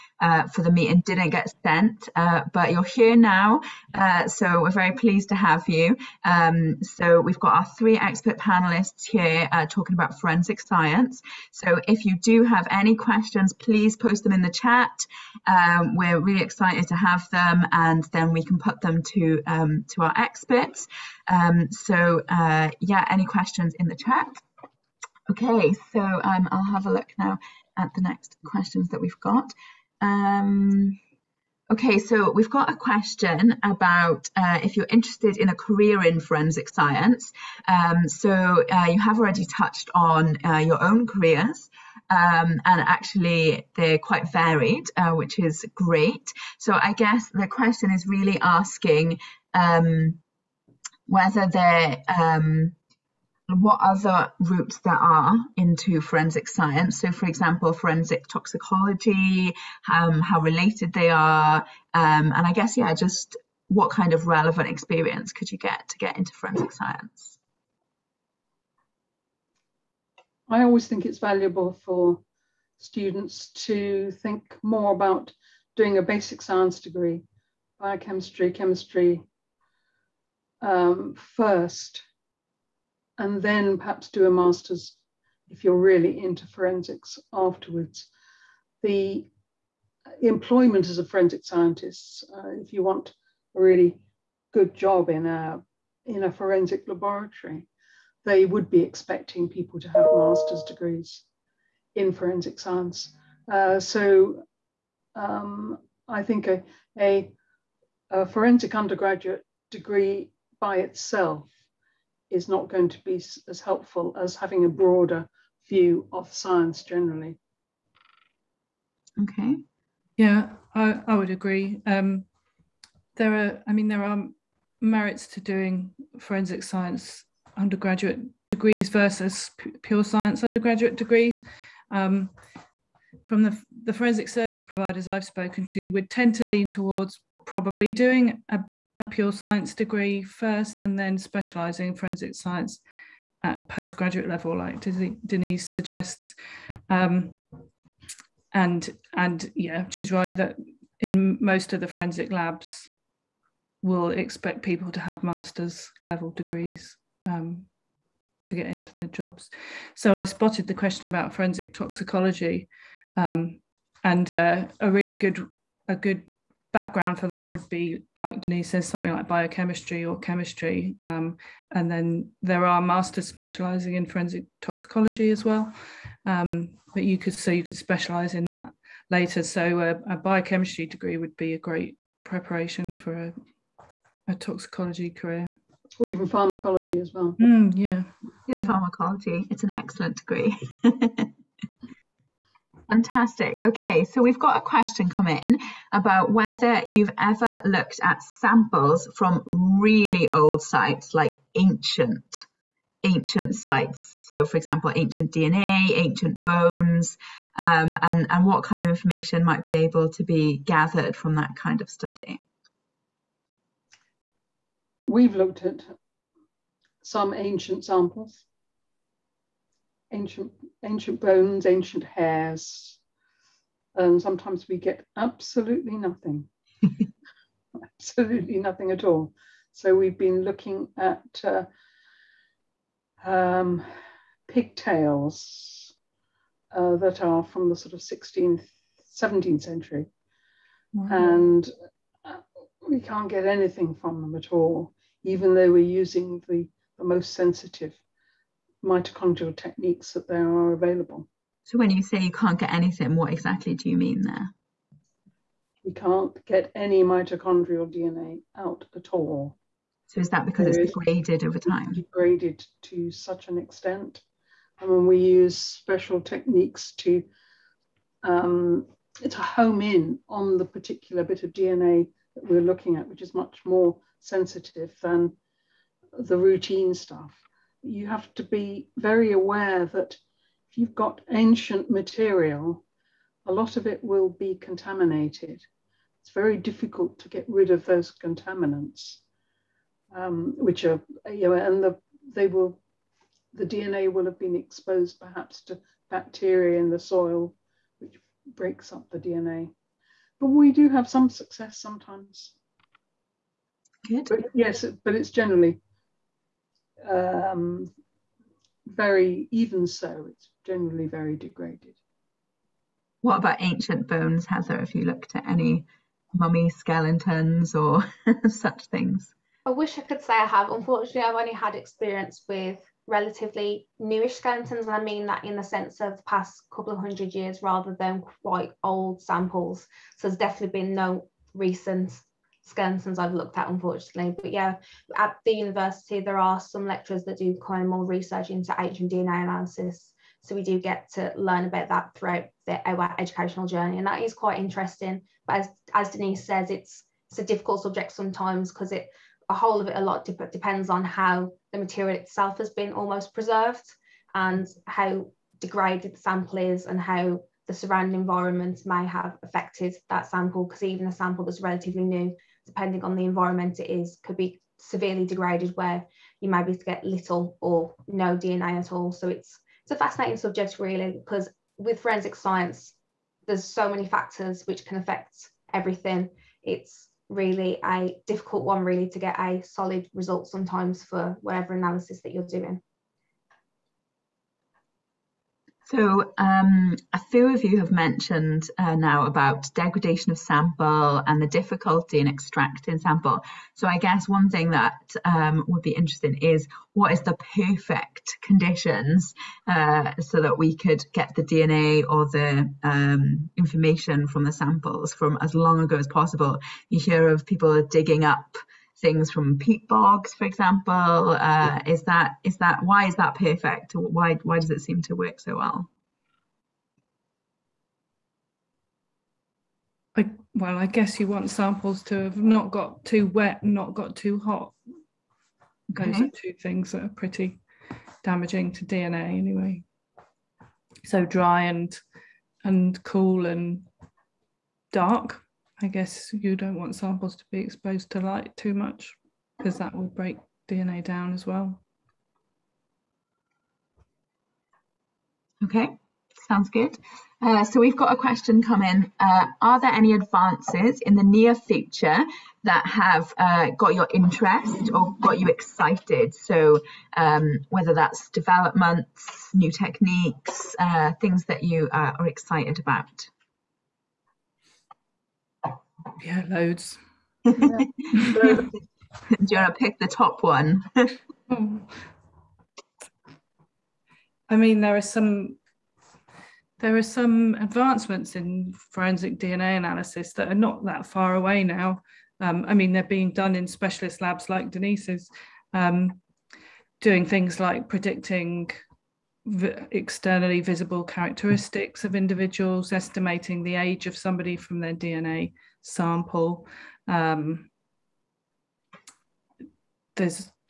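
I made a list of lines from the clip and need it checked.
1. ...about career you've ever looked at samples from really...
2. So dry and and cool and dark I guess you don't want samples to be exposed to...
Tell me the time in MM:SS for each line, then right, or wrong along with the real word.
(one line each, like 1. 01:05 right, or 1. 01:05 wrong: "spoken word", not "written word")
1. 03:15 wrong: "whether", not "career"
2. 07:11 right.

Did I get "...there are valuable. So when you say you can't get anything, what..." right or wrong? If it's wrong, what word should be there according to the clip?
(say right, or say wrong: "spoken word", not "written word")
wrong: "available", not "valuable".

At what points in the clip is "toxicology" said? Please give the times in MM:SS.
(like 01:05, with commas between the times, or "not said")
00:58, 02:41, 02:54, 03:04.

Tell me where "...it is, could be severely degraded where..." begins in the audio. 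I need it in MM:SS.
06:03.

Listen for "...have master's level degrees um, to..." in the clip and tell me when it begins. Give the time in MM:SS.
02:34.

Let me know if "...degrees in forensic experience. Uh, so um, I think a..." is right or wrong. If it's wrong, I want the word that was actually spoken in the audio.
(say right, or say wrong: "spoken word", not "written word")
wrong: "science", not "experience".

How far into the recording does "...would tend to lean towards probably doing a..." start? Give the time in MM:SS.
02:15.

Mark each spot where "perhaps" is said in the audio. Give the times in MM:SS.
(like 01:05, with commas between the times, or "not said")
01:23, 04:55.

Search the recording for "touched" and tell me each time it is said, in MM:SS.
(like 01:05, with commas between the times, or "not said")
00:39.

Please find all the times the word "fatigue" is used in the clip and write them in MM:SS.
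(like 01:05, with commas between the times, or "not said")
not said.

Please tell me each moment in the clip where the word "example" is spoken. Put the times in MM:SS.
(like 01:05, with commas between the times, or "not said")
00:57, 03:24, 06:50.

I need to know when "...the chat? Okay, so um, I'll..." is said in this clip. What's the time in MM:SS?
00:23.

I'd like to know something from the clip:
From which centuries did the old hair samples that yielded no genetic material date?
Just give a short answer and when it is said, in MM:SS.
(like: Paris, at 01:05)
16th and 17th century, at 03:57.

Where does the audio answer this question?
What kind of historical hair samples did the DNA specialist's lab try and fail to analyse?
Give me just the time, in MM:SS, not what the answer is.
03:54.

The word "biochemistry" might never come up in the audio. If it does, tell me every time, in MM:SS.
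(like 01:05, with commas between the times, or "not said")
01:17, 02:49, 03:00.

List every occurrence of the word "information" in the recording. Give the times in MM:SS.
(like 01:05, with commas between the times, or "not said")
03:28, 06:43.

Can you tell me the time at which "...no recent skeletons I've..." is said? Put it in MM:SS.
05:30.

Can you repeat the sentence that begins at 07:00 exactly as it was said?
I, well, I guess you want samples to have not got too wet, not got too hot.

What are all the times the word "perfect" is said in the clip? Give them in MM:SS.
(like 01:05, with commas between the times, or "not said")
06:37, 06:53.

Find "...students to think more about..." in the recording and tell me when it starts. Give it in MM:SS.
01:12.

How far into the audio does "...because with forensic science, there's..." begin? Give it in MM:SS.
06:11.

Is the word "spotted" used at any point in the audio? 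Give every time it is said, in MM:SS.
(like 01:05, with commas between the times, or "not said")
02:40.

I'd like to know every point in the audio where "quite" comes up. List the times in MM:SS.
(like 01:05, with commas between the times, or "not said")
00:43, 05:28, 05:44.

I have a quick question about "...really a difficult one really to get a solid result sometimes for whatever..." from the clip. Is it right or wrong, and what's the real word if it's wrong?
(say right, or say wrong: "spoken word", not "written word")
right.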